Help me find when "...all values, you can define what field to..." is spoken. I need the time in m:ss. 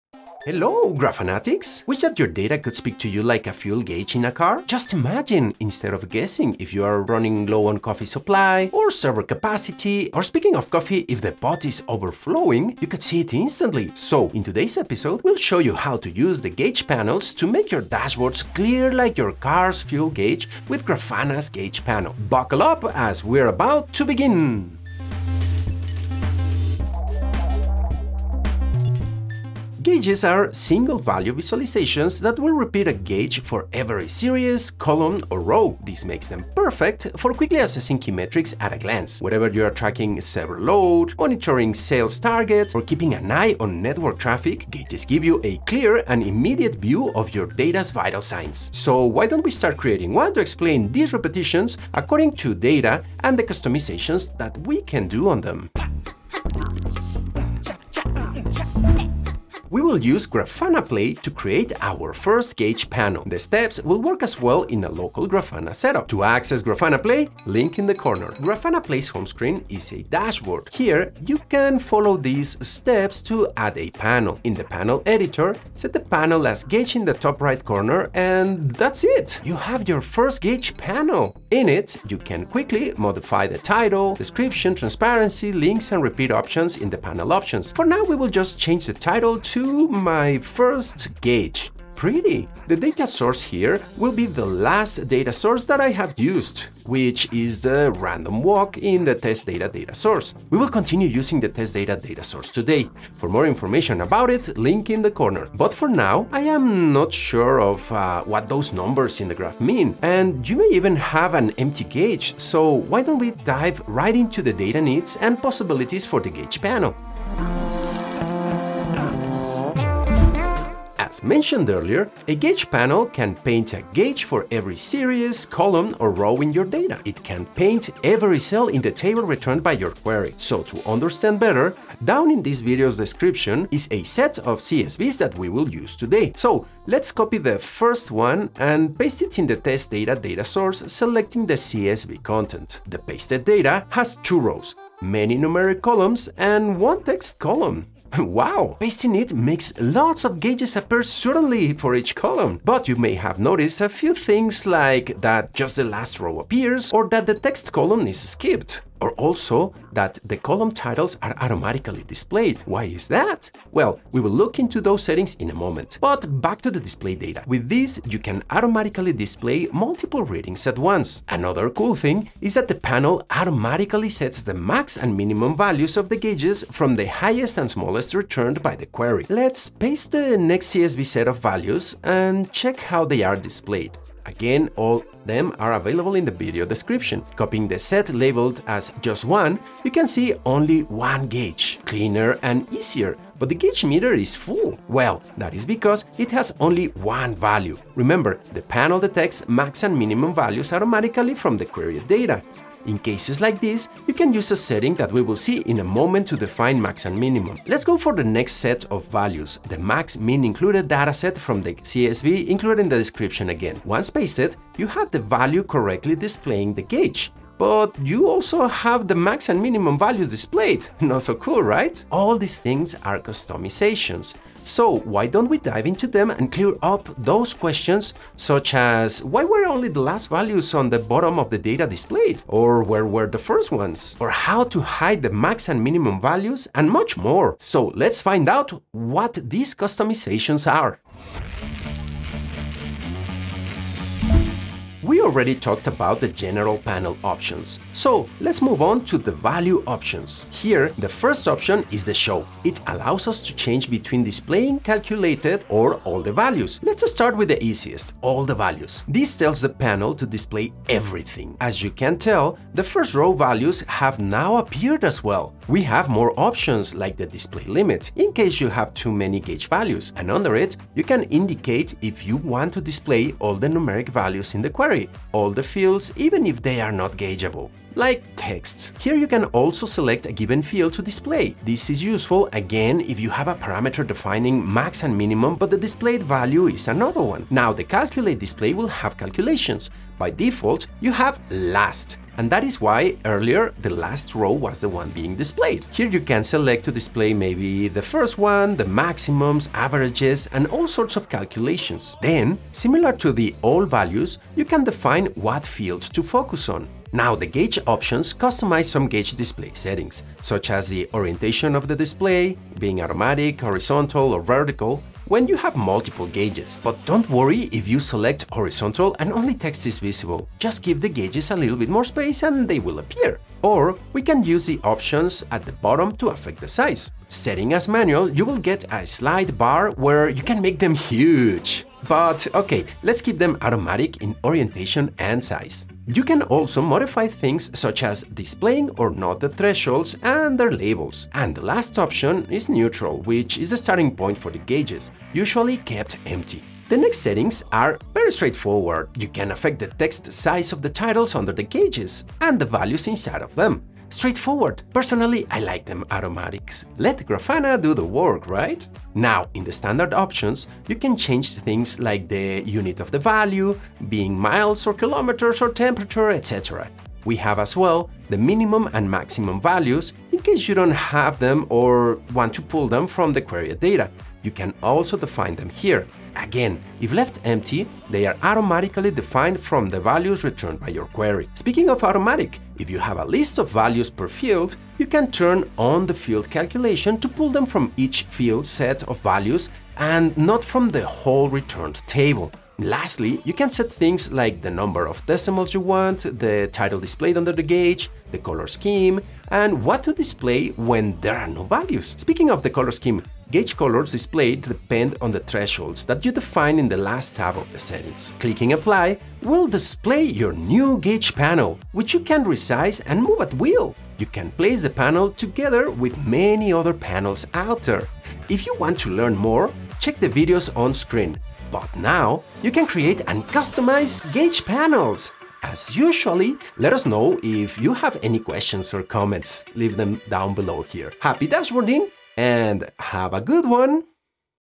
5:03.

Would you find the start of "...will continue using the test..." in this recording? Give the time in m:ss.
1:40.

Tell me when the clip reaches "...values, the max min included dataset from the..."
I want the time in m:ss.
3:29.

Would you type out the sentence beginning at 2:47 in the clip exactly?
With this, you can automatically display multiple readings at once.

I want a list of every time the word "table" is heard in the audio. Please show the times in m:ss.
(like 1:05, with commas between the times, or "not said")
2:08, 6:32.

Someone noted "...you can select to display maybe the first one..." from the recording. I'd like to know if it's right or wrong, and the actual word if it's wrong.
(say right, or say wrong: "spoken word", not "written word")
right.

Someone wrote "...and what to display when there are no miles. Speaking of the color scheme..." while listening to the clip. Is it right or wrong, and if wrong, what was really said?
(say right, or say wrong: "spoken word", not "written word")
wrong: "values", not "miles".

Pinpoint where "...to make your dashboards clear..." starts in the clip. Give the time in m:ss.
0:17.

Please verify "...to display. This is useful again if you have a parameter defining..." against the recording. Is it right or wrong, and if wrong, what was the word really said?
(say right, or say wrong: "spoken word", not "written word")
right.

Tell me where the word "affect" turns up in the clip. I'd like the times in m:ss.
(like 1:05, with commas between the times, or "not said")
5:26, 5:49.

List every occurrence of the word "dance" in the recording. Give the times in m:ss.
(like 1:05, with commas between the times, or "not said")
not said.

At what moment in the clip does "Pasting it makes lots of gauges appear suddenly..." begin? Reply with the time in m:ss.
2:28.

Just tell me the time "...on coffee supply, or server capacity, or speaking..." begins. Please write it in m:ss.
0:07.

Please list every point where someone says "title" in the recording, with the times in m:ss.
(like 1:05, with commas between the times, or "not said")
1:23, 1:28, 2:40, 5:50, 6:36.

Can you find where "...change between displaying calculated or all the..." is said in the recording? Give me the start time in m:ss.
4:13.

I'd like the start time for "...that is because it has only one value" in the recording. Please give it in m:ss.
3:15.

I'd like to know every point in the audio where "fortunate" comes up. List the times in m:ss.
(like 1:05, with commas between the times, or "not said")
not said.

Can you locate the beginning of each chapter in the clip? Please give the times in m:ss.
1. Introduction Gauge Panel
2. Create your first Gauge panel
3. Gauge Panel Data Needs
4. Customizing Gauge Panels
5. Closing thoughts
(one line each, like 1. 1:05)
1. 0:25
2. 0:56
3. 1:57
4. 4:01
5. 6:57.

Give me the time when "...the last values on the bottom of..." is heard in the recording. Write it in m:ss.
3:49.